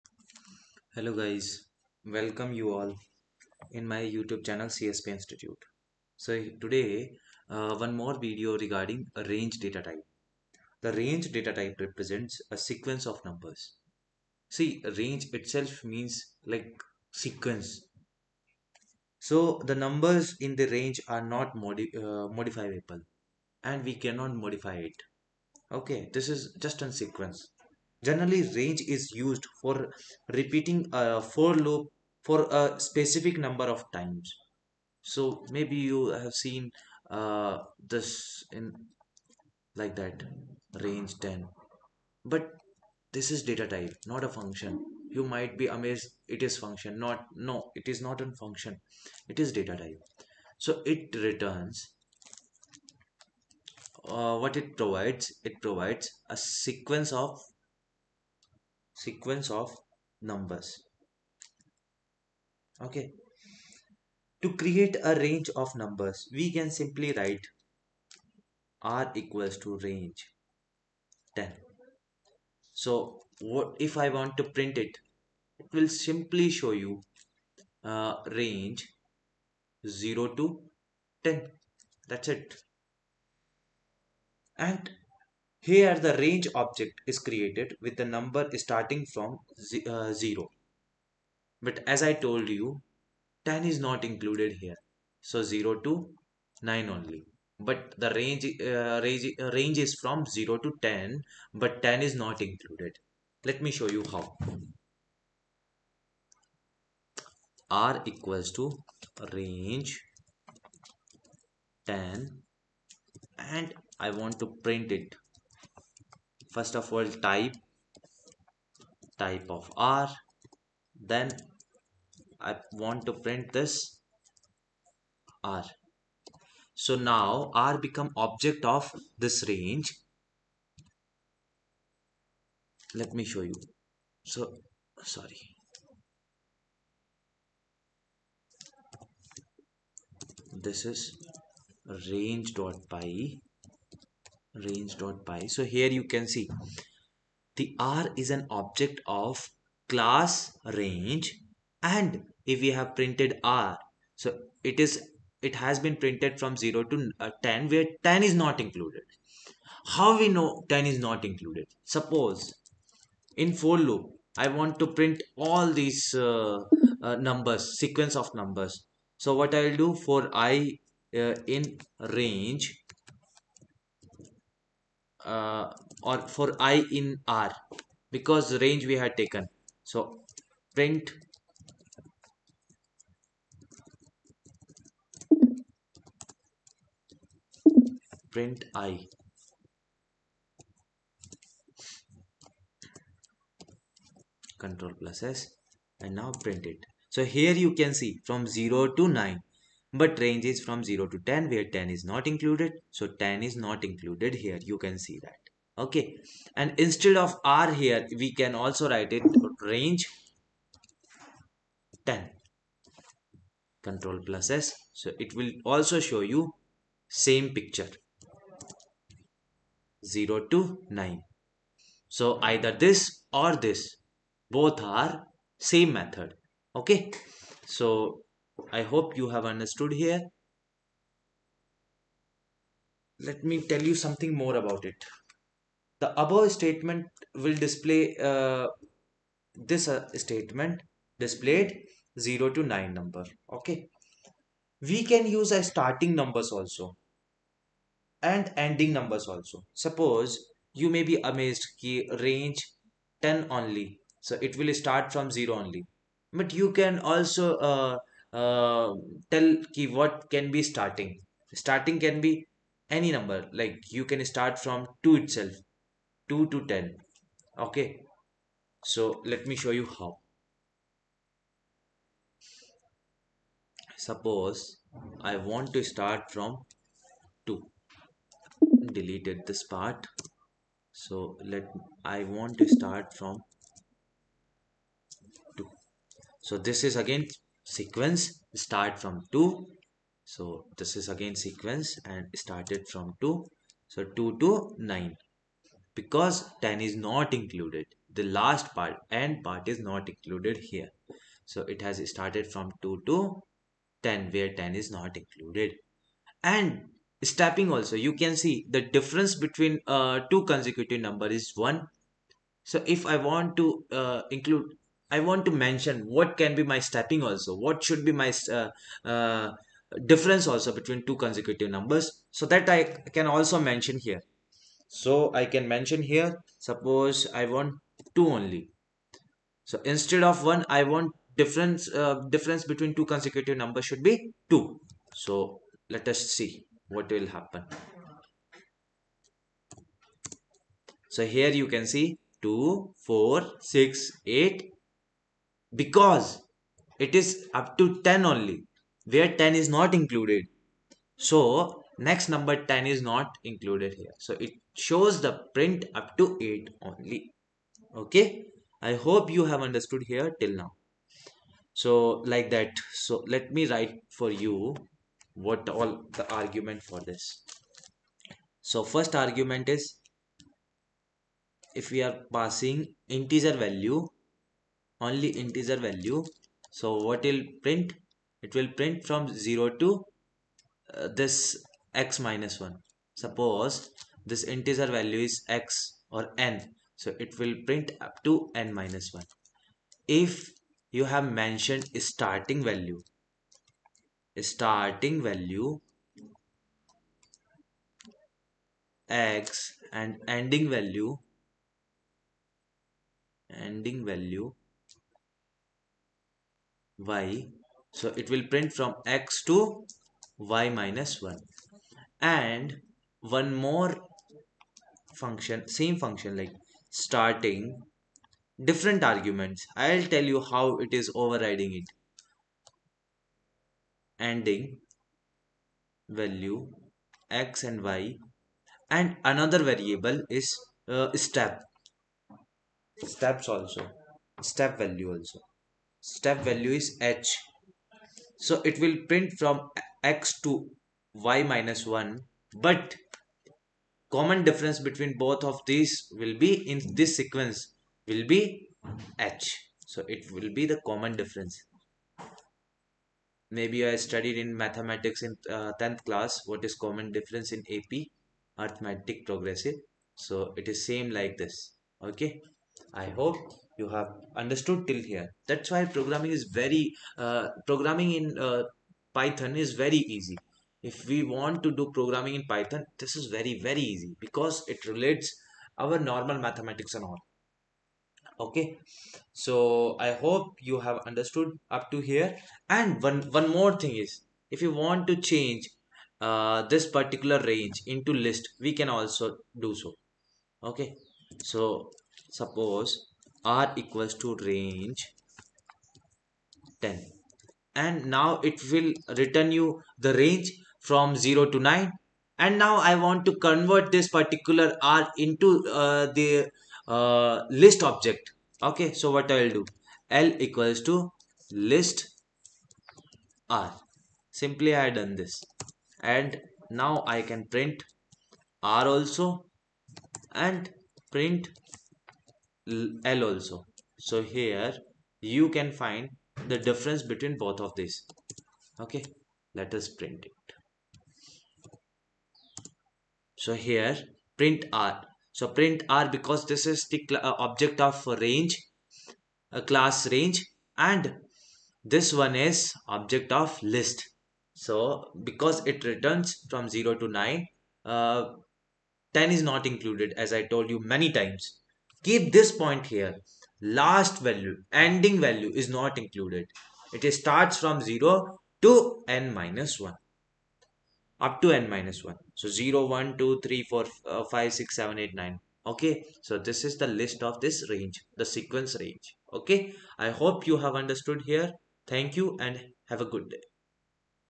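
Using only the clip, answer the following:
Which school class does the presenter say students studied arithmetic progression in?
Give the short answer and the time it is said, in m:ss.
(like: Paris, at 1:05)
10th class, at 7:35.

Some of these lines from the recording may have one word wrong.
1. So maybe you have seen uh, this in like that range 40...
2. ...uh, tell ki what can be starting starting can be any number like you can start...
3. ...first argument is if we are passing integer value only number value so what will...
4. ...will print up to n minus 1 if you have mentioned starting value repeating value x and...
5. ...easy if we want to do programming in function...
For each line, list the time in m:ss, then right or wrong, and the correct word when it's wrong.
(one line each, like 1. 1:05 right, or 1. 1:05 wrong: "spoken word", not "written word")
1. 0:35 wrong: "10", not "40"
2. 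4:18 right
3. 6:08 wrong: "integer", not "number"
4. 6:27 wrong: "starting", not "repeating"
5. 7:50 wrong: "python", not "function".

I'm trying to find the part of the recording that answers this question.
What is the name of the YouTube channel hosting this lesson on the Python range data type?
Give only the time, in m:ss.
0:04.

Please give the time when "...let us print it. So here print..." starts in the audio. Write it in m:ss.
8:49.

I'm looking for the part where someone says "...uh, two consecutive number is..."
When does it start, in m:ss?
5:09.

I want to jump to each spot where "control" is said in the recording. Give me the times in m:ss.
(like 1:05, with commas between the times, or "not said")
3:14, 3:33.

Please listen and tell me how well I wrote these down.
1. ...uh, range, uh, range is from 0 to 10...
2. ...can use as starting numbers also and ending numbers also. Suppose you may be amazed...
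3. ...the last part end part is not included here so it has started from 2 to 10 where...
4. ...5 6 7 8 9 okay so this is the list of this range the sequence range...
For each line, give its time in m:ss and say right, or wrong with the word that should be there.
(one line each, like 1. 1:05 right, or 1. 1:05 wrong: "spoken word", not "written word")
1. 1:38 right
2. 4:05 right
3. 4:58 right
4. 9:24 right.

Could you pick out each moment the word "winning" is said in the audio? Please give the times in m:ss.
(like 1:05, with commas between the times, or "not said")
not said.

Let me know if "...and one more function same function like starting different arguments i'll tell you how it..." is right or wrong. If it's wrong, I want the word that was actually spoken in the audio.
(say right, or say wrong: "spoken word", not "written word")
right.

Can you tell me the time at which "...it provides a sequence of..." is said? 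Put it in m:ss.
0:55.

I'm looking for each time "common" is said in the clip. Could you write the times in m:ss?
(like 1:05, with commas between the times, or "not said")
7:24, 7:30, 7:36.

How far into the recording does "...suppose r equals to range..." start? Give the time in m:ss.
8:12.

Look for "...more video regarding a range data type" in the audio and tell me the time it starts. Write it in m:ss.
0:07.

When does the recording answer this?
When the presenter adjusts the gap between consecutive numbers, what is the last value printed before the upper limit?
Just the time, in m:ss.
5:55.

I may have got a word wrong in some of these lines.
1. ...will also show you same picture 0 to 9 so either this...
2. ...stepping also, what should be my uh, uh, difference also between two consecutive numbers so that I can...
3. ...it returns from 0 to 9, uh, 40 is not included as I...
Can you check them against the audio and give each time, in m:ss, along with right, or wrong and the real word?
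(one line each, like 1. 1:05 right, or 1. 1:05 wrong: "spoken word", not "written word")
1. 3:35 right
2. 5:16 right
3. 9:05 wrong: "10", not "40".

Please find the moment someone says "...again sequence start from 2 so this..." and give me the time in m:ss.
4:46.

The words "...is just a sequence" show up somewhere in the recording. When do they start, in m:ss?
0:26.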